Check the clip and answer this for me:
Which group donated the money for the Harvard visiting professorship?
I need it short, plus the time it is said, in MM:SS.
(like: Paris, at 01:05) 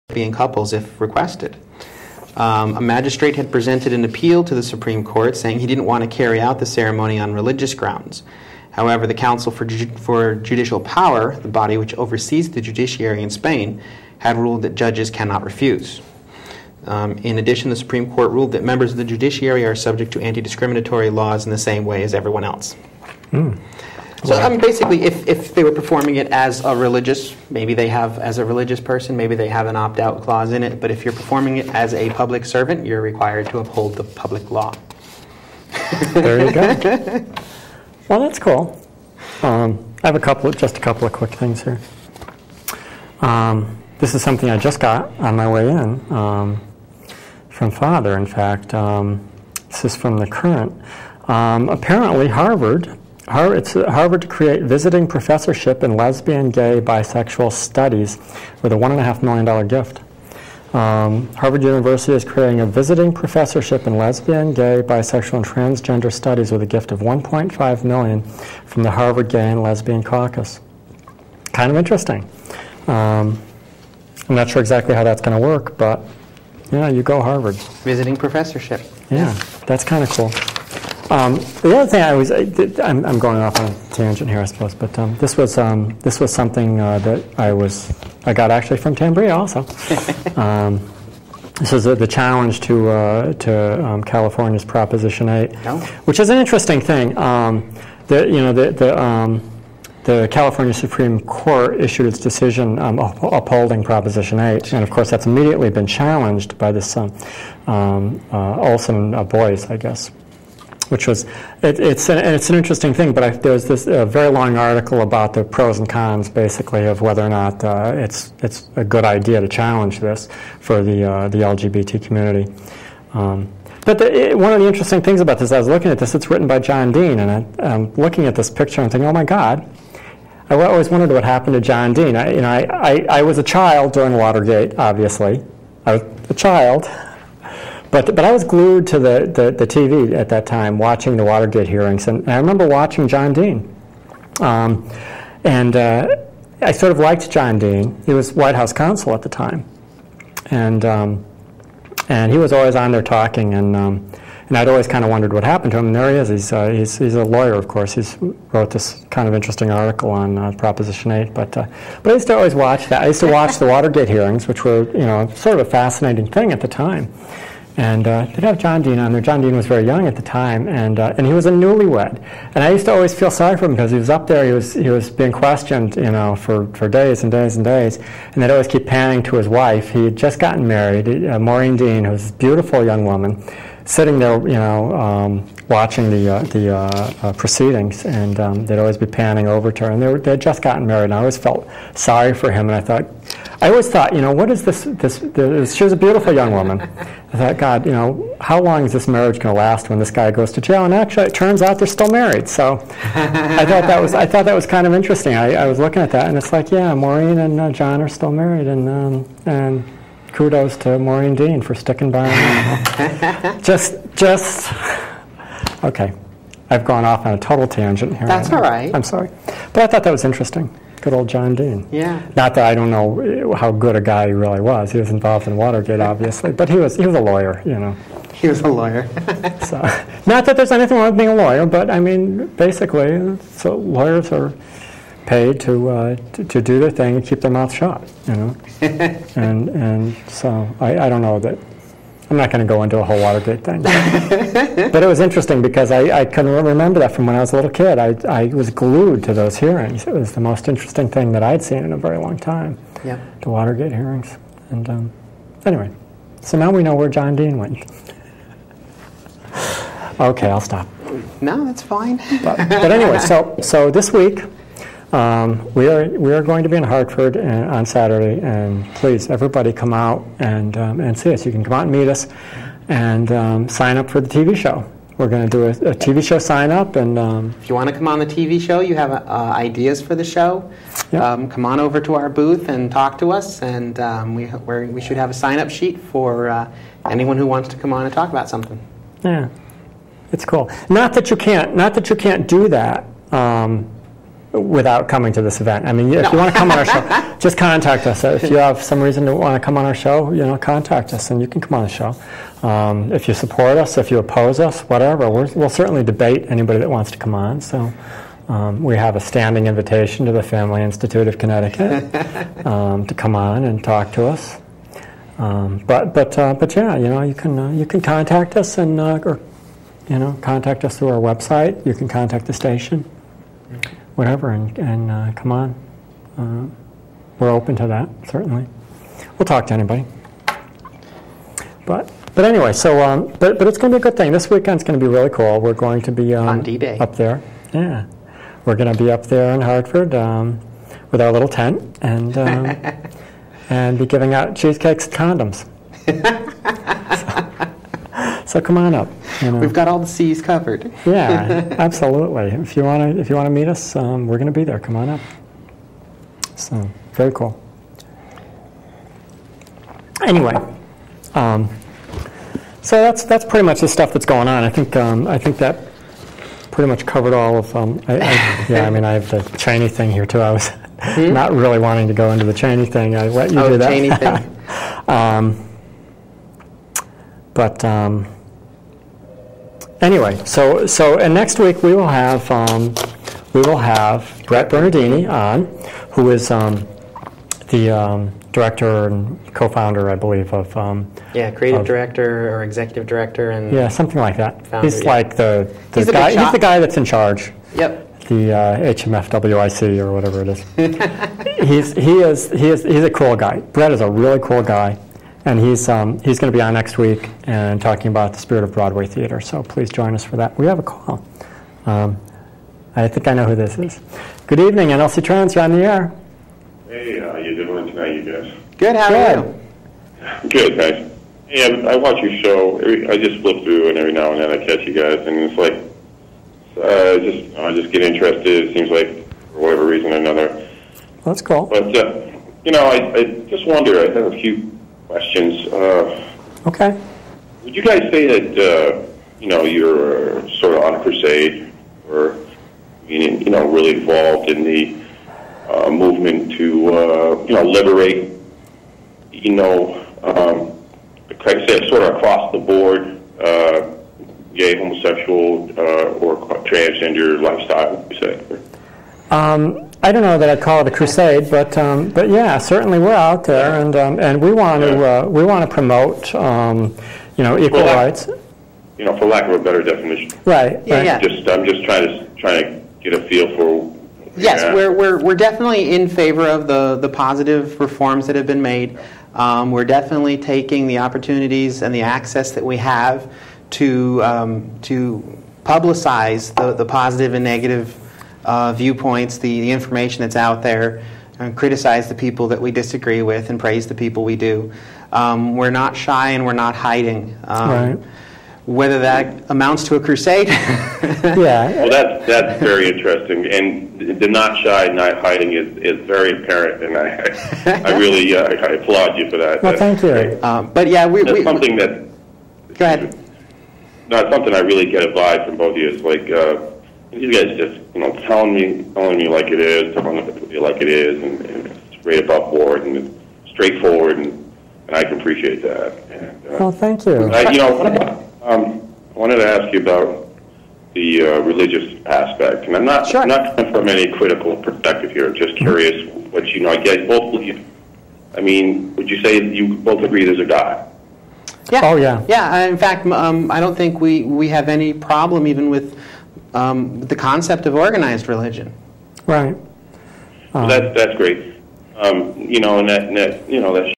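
Harvard Gay and Lesbian Caucus, at 01:08.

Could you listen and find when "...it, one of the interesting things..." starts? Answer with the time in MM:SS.
02:04.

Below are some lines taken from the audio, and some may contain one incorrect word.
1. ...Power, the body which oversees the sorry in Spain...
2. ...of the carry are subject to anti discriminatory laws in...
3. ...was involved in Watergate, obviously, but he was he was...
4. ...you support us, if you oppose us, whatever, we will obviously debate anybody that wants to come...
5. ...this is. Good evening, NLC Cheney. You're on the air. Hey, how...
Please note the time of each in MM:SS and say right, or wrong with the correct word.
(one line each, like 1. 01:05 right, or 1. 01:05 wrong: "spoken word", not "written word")
1. 00:10 wrong: "judiciary", not "sorry"
2. 00:18 wrong: "judiciary", not "carry"
3. 03:44 right
4. 05:03 wrong: "certainly", not "obviously"
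5. 06:53 wrong: "Trans", not "Cheney".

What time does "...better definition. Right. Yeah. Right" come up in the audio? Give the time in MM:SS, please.
07:49.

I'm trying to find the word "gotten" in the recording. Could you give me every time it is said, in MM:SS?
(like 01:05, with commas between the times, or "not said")
03:00, 03:10.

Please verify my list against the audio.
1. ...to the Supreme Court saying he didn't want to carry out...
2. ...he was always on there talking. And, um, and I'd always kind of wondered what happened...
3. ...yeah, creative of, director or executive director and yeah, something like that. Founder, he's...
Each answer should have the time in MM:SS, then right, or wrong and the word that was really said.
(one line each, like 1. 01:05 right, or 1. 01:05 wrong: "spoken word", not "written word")
1. 00:04 right
2. 02:32 right
3. 06:31 right.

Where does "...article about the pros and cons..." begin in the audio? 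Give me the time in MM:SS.
01:54.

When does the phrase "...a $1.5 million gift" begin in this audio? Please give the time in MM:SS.
00:58.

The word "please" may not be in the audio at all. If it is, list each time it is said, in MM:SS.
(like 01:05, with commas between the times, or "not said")
04:28, 06:49.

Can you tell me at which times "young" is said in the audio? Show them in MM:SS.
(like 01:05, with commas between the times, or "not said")
02:49, 03:02, 03:16.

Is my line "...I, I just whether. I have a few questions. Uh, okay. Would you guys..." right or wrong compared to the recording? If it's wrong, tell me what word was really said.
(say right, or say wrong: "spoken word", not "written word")
wrong: "wonder", not "whether".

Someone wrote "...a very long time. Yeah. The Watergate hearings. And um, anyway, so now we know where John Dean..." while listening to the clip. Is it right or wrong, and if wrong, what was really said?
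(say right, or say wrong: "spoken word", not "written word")
right.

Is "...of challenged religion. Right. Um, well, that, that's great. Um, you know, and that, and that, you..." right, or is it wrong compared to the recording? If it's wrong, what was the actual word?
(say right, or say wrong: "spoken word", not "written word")
wrong: "organized", not "challenged".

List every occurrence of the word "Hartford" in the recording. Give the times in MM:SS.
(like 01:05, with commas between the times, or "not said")
04:26, 05:39.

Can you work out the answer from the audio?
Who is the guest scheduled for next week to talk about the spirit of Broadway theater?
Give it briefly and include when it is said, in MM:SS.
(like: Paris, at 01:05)
Brett Bernardini, at 06:24.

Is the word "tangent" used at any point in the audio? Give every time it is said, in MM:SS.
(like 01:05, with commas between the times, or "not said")
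01:23, 03:37.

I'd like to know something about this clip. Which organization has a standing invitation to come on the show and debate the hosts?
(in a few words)
Family Institute of Connecticut.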